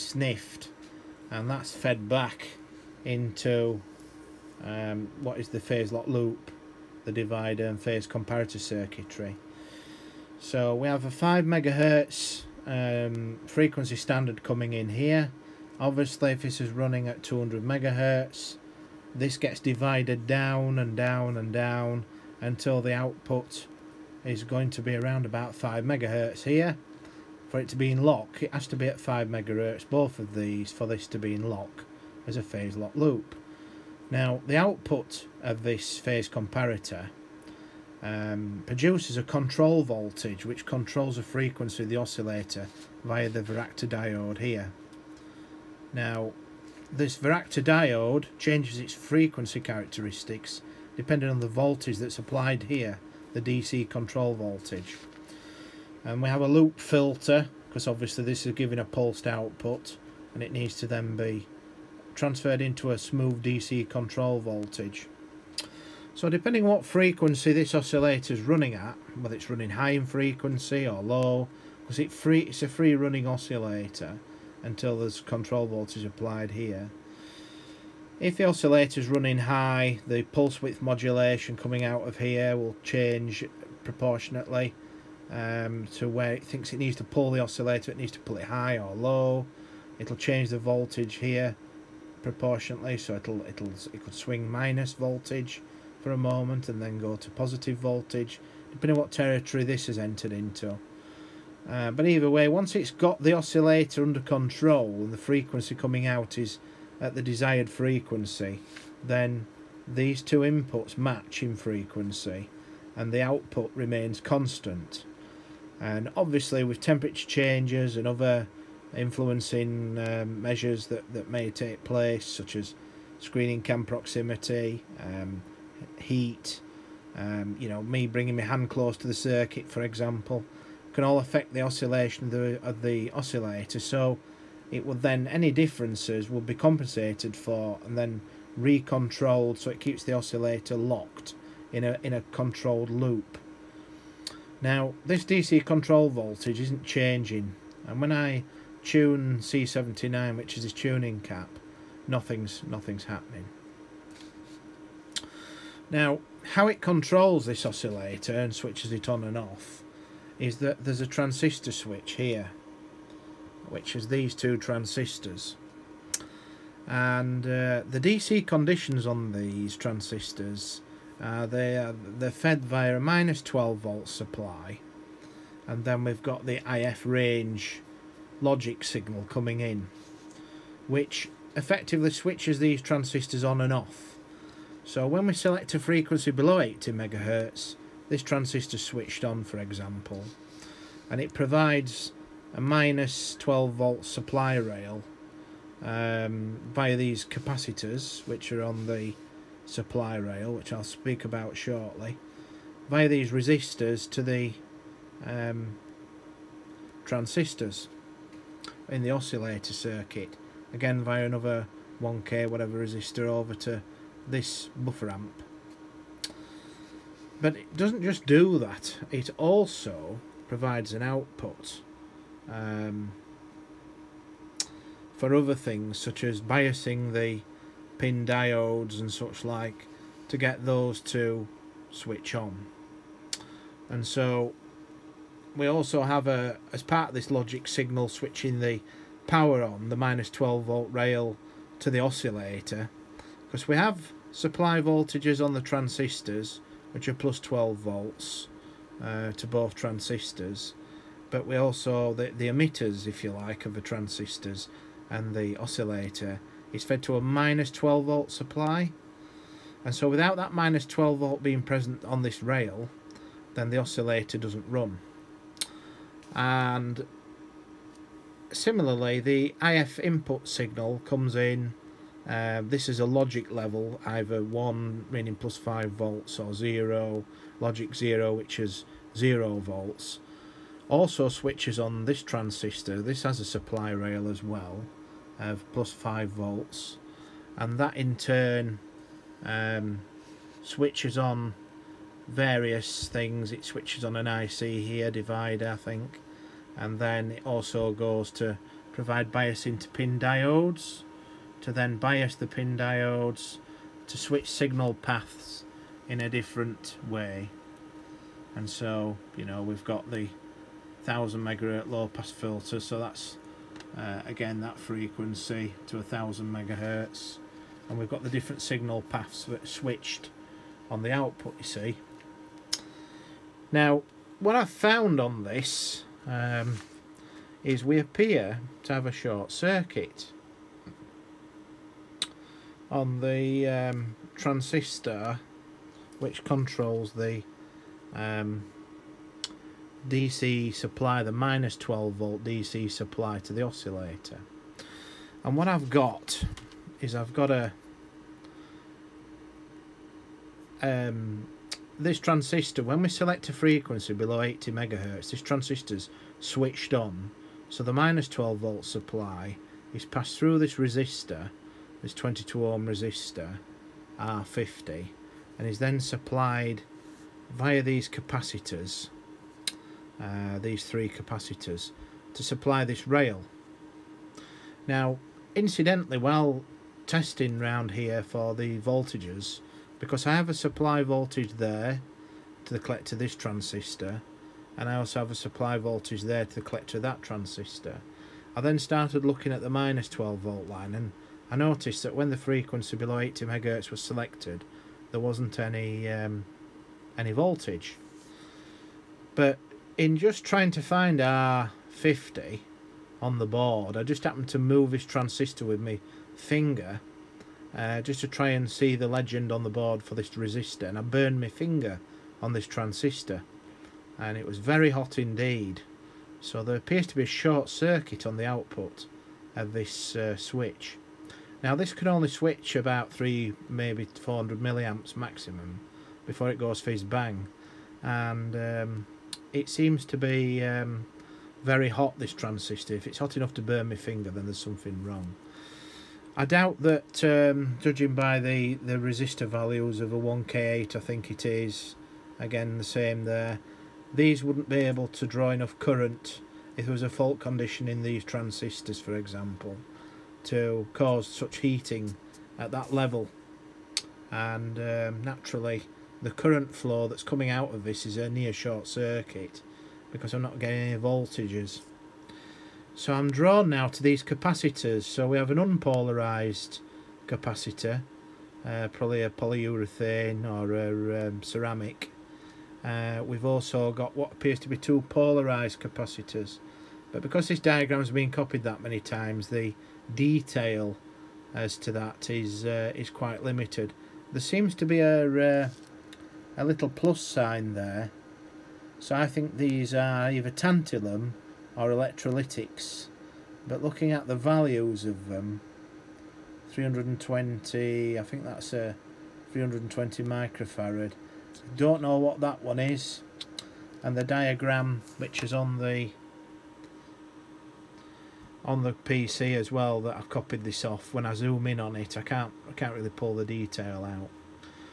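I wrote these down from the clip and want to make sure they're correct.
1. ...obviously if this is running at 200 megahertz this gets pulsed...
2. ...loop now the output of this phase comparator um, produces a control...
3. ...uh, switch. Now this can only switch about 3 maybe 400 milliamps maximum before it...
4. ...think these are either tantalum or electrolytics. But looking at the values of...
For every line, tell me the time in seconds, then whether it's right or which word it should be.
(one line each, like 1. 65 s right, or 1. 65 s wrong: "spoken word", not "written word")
1. 15 s wrong: "divided", not "pulsed"
2. 32 s right
3. 420 s right
4. 489 s right.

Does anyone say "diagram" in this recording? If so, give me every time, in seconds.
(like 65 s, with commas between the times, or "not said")
477 s, 504 s.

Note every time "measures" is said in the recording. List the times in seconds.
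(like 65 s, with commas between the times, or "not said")
120 s.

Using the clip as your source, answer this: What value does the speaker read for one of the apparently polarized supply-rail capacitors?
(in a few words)
320 microfarad.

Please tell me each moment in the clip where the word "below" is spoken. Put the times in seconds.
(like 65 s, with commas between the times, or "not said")
186 s, 354 s, 392 s.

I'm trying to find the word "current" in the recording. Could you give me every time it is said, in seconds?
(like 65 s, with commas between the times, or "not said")
445 s, 456 s.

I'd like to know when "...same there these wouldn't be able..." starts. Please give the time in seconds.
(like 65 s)
442 s.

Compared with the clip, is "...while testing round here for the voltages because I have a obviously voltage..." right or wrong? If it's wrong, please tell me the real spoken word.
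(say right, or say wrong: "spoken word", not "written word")
wrong: "supply", not "obviously".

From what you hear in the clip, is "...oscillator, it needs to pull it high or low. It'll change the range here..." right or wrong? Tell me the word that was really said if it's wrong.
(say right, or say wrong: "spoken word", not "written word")
wrong: "voltage", not "range".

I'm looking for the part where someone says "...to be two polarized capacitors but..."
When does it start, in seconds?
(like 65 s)
474 s.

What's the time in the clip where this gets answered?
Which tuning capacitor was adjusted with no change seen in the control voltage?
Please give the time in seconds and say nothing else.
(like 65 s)
149 s.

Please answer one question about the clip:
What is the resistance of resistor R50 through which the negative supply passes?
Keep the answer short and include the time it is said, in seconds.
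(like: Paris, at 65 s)
22 ohms, at 362 s.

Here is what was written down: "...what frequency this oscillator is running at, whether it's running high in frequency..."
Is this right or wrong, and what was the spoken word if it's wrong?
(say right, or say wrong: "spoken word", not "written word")
right.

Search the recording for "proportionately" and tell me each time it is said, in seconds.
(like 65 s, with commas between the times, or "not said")
83 s, 92 s.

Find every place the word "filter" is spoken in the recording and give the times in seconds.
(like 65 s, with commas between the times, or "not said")
56 s, 312 s.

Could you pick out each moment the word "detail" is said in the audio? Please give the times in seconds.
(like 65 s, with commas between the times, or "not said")
480 s, 513 s.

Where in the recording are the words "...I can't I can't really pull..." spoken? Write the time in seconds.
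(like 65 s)
512 s.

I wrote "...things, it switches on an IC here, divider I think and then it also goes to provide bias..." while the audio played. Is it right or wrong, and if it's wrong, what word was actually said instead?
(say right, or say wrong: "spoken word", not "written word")
right.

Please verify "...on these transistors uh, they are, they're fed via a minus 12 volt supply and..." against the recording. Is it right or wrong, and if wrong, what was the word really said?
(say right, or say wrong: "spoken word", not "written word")
right.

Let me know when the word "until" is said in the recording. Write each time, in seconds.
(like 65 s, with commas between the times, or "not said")
22 s, 74 s.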